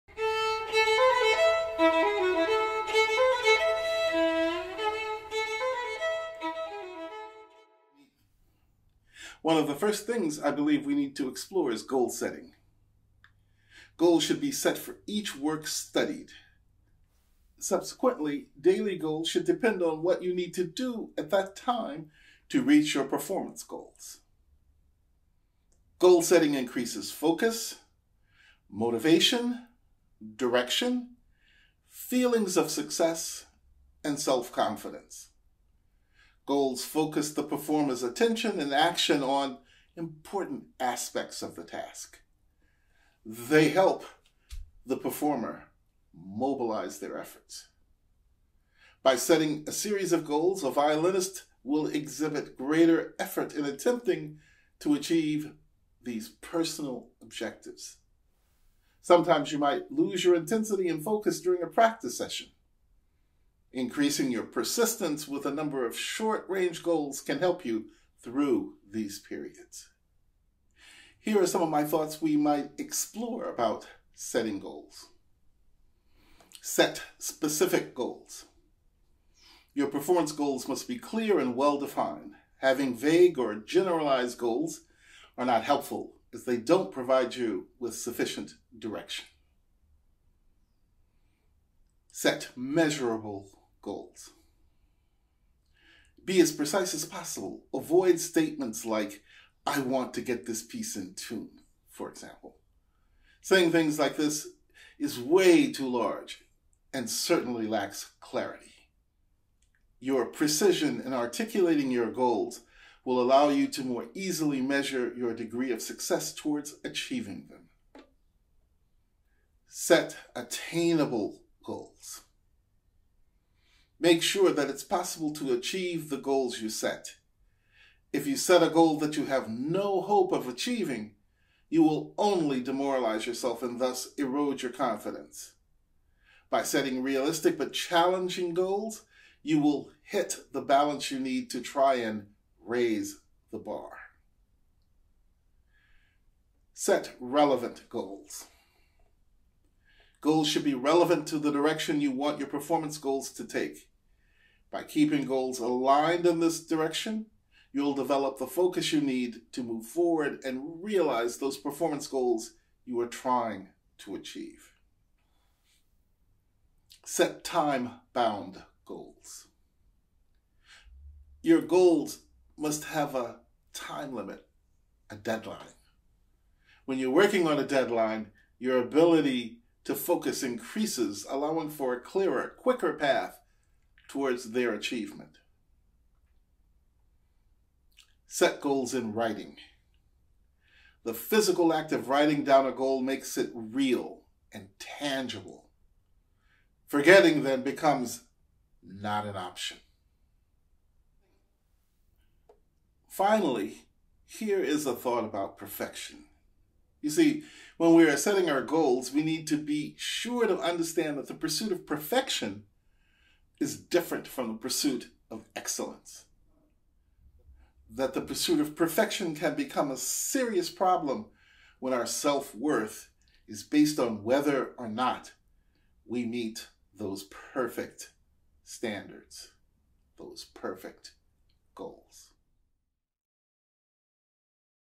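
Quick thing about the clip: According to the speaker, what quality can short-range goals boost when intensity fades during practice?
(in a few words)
Persistence.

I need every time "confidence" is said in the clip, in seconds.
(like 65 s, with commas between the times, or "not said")
34 s, 134 s.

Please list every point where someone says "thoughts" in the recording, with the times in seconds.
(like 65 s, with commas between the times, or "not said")
71 s, 204 s.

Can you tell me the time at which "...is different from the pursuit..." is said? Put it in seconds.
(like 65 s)
213 s.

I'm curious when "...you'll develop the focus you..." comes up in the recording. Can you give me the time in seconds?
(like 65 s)
157 s.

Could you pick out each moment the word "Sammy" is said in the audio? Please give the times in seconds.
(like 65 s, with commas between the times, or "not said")
not said.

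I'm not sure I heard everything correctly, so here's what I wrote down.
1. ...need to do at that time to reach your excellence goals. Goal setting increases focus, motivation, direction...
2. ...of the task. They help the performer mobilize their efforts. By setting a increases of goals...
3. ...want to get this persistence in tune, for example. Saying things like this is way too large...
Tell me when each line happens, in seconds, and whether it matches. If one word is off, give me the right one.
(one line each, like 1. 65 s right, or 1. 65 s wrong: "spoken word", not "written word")
1. 20 s wrong: "performance", not "excellence"
2. 41 s wrong: "series", not "increases"
3. 99 s wrong: "piece", not "persistence".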